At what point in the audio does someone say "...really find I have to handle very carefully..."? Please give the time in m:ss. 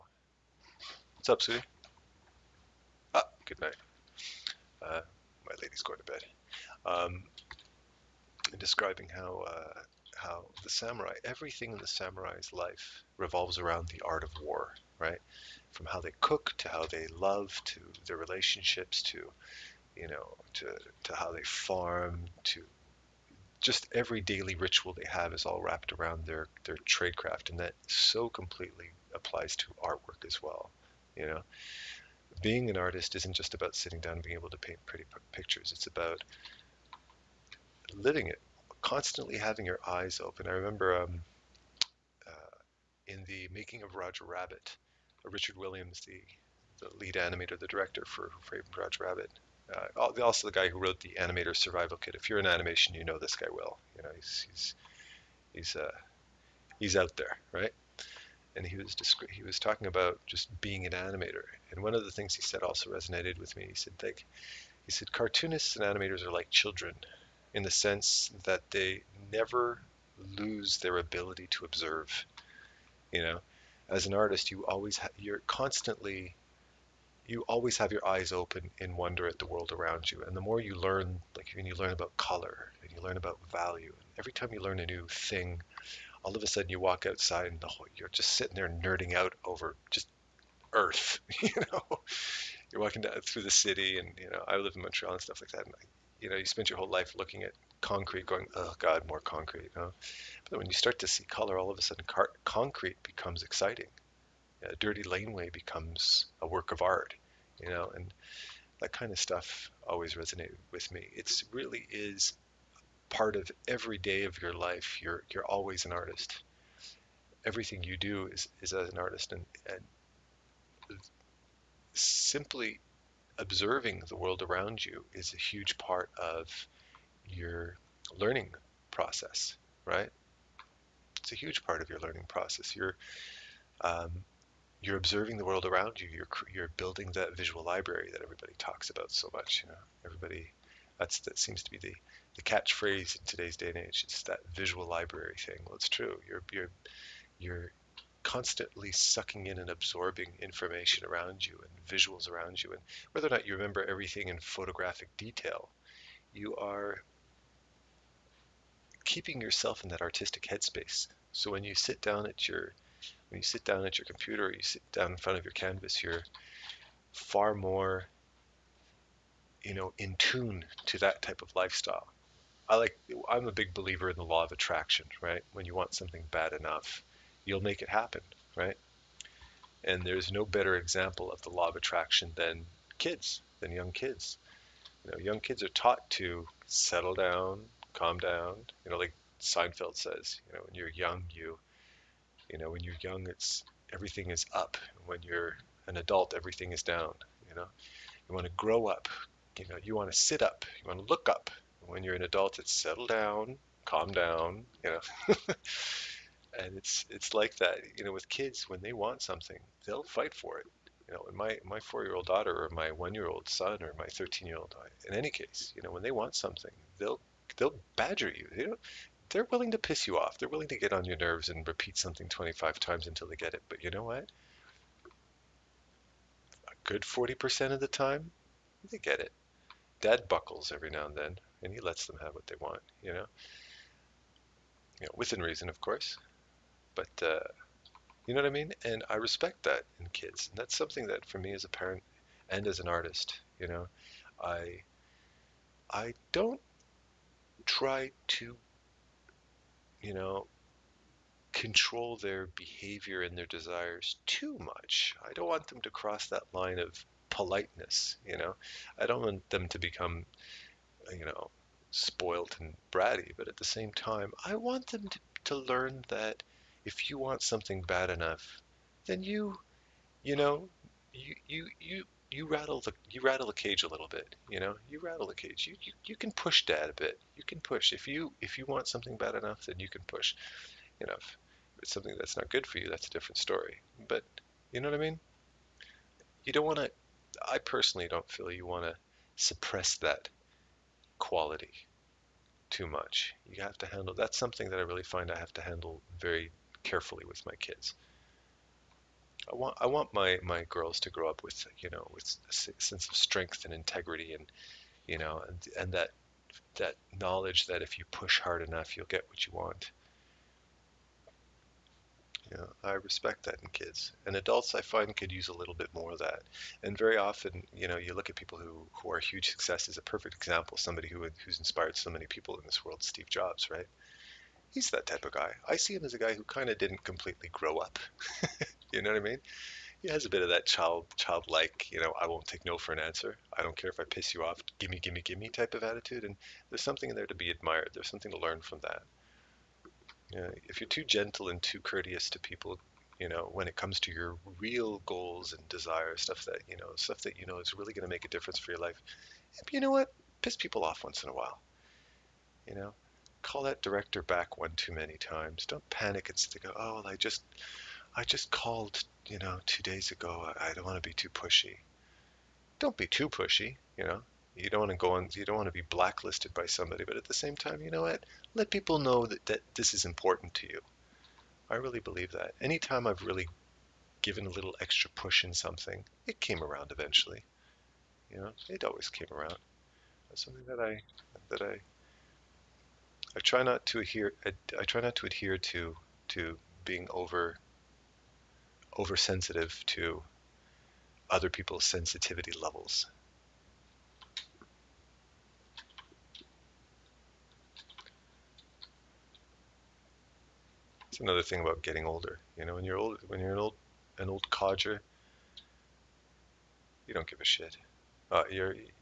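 4:54.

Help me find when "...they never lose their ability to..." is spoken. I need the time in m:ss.
1:08.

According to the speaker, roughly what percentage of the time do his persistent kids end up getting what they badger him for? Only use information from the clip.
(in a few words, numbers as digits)
40%.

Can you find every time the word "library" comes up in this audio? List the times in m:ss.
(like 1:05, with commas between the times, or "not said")
2:17, 2:24.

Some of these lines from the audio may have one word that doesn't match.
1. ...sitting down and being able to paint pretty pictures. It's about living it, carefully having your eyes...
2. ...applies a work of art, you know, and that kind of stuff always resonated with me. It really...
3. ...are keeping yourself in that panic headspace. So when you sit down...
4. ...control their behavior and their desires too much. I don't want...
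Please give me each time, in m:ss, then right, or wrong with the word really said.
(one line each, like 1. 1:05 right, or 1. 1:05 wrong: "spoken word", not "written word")
1. 0:33 wrong: "constantly", not "carefully"
2. 1:45 wrong: "becomes", not "applies"
3. 2:36 wrong: "artistic", not "panic"
4. 4:11 right.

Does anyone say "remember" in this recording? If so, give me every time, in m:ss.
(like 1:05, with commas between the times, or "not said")
0:40, 2:33.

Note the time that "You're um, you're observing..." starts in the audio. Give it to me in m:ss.
2:12.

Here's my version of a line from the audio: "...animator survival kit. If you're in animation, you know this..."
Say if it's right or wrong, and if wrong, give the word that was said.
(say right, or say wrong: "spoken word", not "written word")
right.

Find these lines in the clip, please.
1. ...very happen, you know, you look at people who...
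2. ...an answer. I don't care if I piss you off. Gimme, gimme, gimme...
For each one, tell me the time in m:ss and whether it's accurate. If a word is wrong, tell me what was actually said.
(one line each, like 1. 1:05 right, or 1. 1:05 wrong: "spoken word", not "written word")
1. 5:16 wrong: "often", not "happen"
2. 5:32 right.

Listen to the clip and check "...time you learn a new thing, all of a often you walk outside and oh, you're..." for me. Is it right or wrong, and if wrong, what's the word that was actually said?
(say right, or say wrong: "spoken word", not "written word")
wrong: "sudden", not "often".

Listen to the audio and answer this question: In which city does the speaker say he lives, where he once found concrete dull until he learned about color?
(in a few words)
Montreal.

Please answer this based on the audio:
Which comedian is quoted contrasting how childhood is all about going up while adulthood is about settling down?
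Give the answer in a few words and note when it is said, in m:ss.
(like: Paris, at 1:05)
Seinfeld, at 3:09.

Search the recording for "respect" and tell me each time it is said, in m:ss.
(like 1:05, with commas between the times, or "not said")
3:59, 5:12.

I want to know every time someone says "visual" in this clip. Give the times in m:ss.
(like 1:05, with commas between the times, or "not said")
2:17, 2:24, 2:31.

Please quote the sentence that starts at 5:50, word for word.
Piss people off once in a while.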